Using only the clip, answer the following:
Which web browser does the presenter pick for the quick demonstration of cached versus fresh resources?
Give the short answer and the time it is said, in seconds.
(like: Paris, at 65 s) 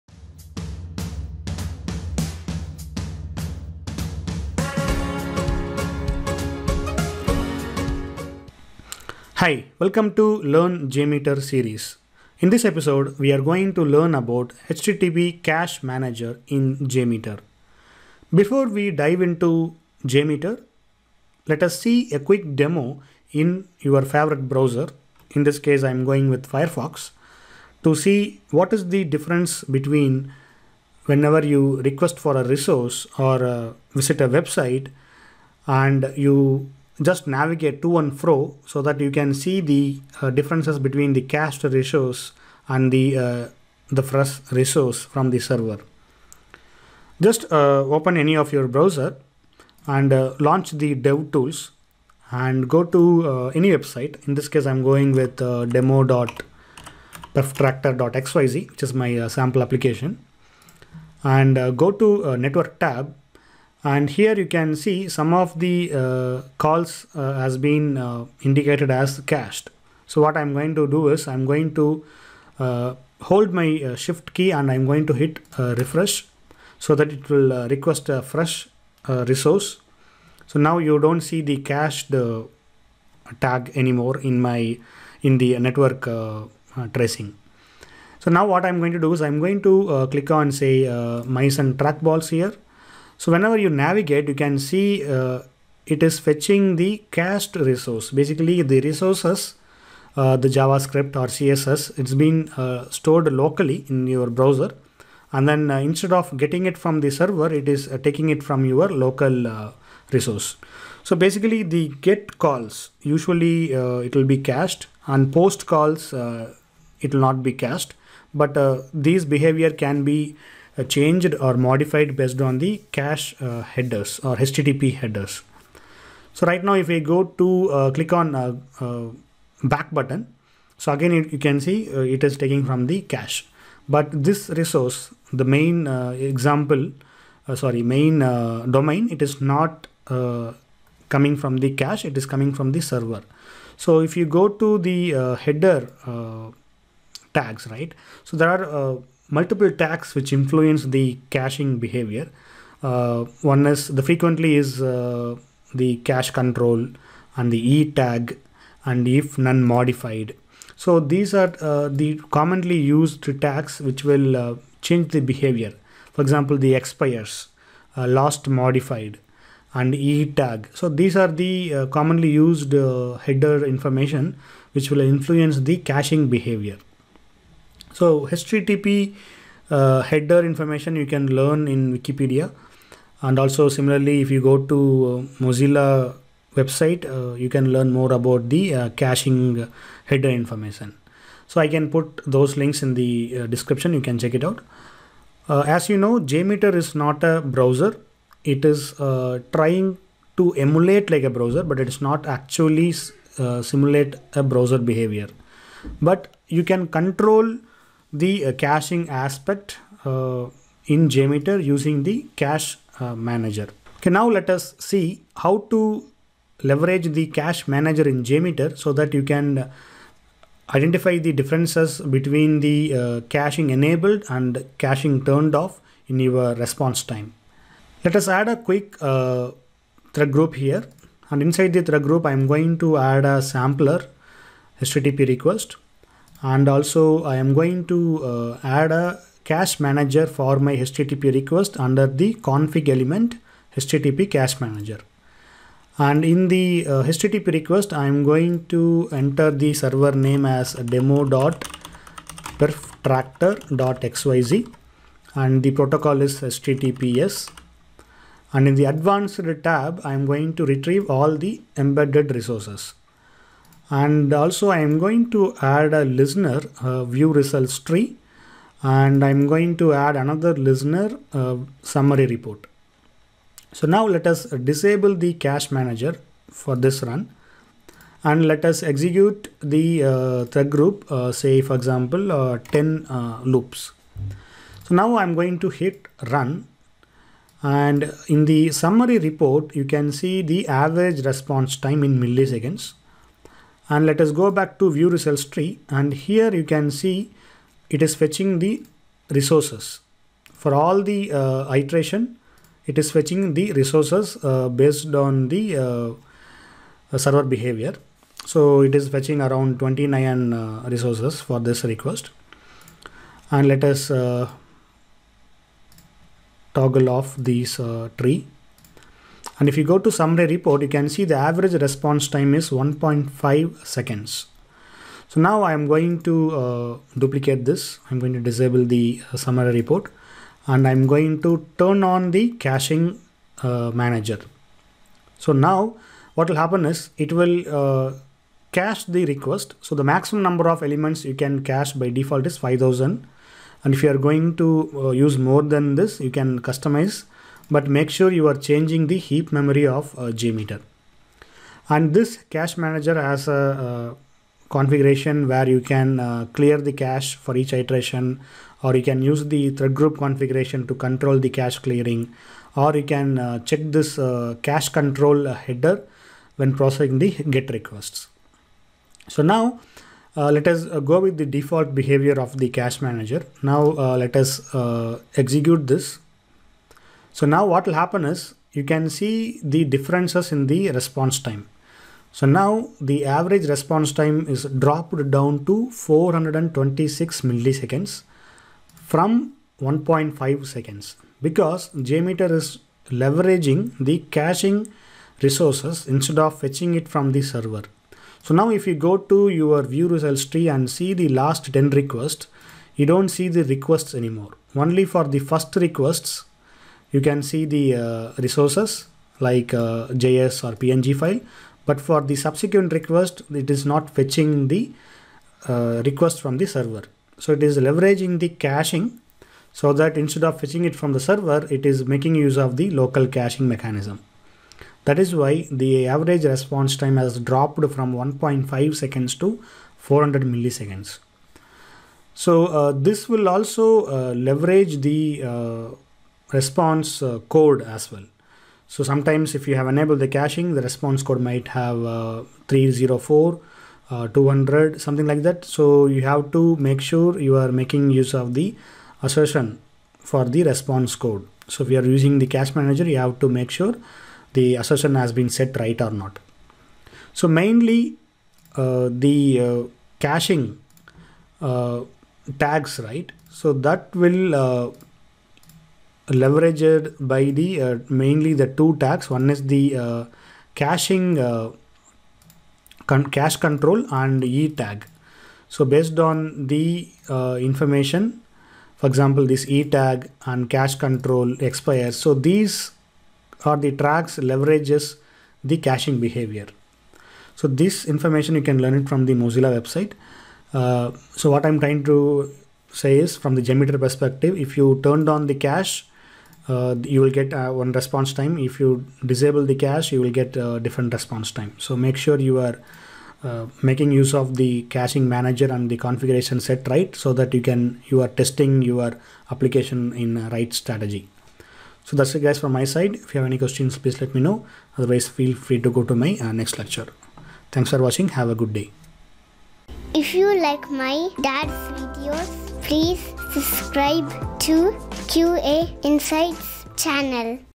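Firefox, at 26 s.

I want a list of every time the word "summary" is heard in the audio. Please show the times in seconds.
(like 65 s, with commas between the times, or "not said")
271 s, 288 s, 320 s, 329 s.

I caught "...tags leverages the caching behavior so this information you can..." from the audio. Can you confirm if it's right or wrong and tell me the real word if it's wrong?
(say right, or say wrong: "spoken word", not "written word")
right.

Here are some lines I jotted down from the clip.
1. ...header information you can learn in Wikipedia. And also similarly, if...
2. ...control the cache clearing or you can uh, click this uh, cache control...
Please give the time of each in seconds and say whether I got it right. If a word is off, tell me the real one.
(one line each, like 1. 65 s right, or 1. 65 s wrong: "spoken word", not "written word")
1. 180 s right
2. 360 s wrong: "check", not "click".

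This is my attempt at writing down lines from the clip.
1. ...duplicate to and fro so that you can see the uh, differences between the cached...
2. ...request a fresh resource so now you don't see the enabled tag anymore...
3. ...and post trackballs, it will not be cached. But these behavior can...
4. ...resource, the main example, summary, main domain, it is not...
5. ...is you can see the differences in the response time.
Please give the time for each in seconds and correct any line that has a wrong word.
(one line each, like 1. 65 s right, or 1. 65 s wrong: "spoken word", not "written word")
1. 37 s wrong: "navigate", not "duplicate"
2. 77 s wrong: "cached", not "enabled"
3. 115 s wrong: "calls", not "trackballs"
4. 134 s wrong: "sorry", not "summary"
5. 378 s right.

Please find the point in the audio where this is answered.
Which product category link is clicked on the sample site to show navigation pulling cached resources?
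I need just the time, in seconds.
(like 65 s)
91 s.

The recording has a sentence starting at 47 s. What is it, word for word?
Just uh, open any of your browser and uh, launch the dev tools and go to uh, any website.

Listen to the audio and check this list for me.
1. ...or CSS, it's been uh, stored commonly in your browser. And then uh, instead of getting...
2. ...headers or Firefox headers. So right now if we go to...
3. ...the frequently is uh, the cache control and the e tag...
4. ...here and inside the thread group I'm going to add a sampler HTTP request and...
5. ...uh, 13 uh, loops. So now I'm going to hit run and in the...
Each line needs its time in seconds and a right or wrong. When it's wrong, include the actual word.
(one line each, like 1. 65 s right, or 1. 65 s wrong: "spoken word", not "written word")
1. 101 s wrong: "locally", not "commonly"
2. 123 s wrong: "HTTP", not "Firefox"
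3. 153 s right
4. 230 s right
5. 282 s wrong: "10", not "13".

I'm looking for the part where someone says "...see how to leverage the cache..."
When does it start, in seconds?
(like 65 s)
214 s.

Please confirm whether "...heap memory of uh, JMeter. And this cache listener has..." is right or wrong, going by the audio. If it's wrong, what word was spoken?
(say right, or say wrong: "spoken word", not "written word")
wrong: "manager", not "listener".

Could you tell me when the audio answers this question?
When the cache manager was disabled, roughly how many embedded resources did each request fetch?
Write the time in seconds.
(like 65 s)
309 s.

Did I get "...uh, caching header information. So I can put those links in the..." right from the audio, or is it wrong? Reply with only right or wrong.
right.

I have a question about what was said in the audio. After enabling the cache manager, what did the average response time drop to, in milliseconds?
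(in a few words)
426 milliseconds.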